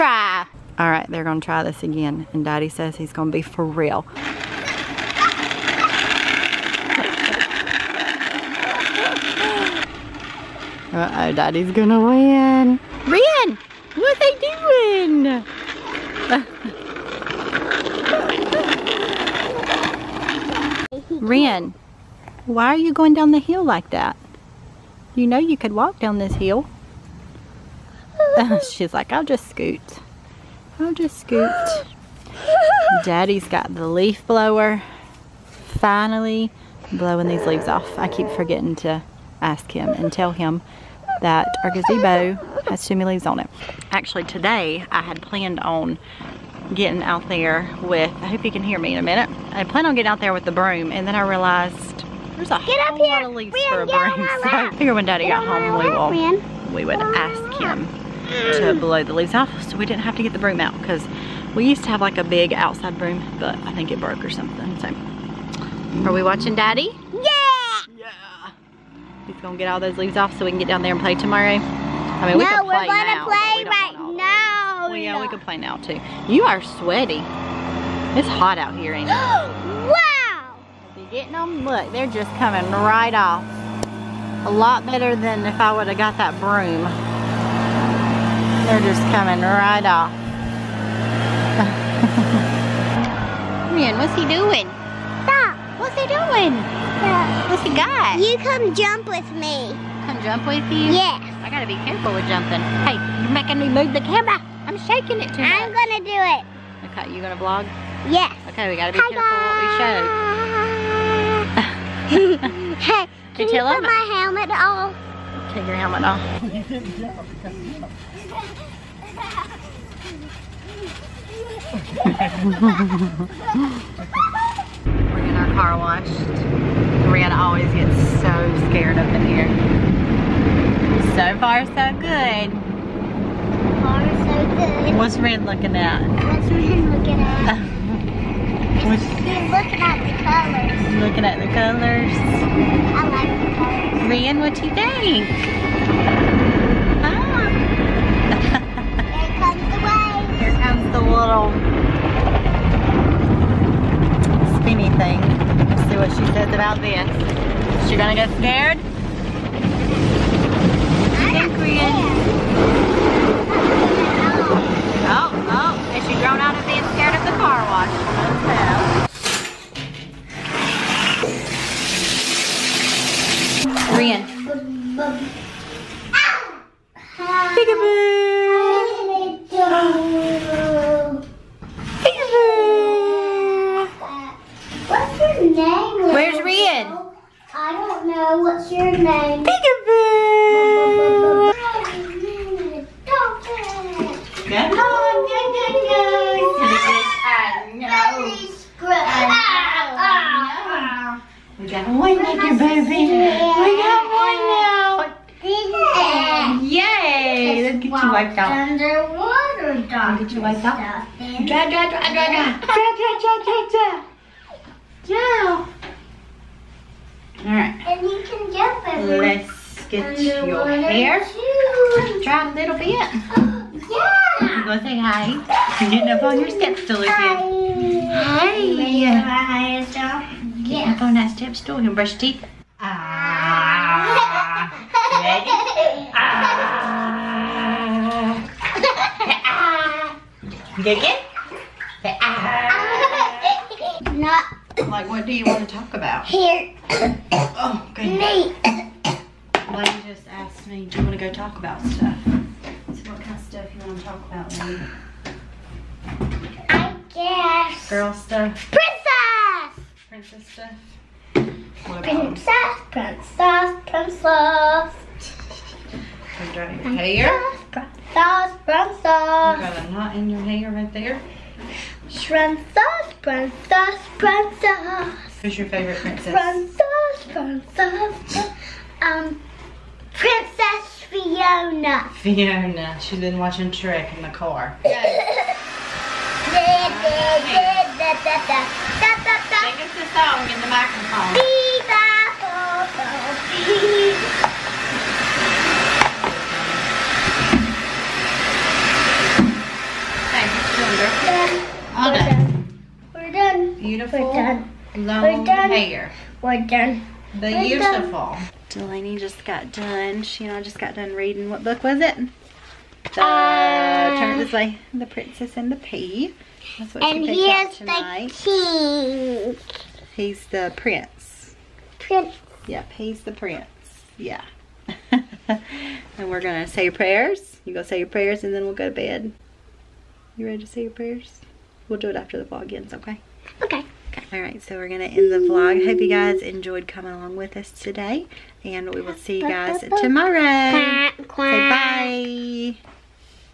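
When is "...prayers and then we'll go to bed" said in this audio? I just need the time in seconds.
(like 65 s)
328 s.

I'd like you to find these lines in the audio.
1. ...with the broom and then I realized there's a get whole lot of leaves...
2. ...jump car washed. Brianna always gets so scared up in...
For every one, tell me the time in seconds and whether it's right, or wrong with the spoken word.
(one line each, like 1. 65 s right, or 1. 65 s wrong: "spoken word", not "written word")
1. 50 s right
2. 123 s right.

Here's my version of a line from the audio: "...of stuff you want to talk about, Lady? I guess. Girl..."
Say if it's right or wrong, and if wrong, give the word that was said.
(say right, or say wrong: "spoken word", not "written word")
right.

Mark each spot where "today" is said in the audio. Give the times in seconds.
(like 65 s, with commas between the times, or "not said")
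44 s, 337 s.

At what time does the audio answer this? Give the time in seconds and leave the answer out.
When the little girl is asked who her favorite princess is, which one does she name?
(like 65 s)
280 s.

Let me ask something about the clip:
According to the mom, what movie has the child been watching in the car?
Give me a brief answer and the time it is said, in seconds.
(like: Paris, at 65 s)
Shrek, at 283 s.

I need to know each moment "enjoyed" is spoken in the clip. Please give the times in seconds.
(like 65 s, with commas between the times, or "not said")
336 s.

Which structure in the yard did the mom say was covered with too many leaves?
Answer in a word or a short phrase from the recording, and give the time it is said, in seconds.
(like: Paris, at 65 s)
Gazebo, at 41 s.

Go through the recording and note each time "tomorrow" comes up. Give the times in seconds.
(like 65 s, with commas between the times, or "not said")
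71 s, 340 s.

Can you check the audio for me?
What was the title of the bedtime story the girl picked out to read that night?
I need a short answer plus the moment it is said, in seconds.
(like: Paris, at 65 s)
The Princess and the Pea, at 314 s.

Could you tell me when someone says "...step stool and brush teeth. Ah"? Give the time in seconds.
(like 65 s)
231 s.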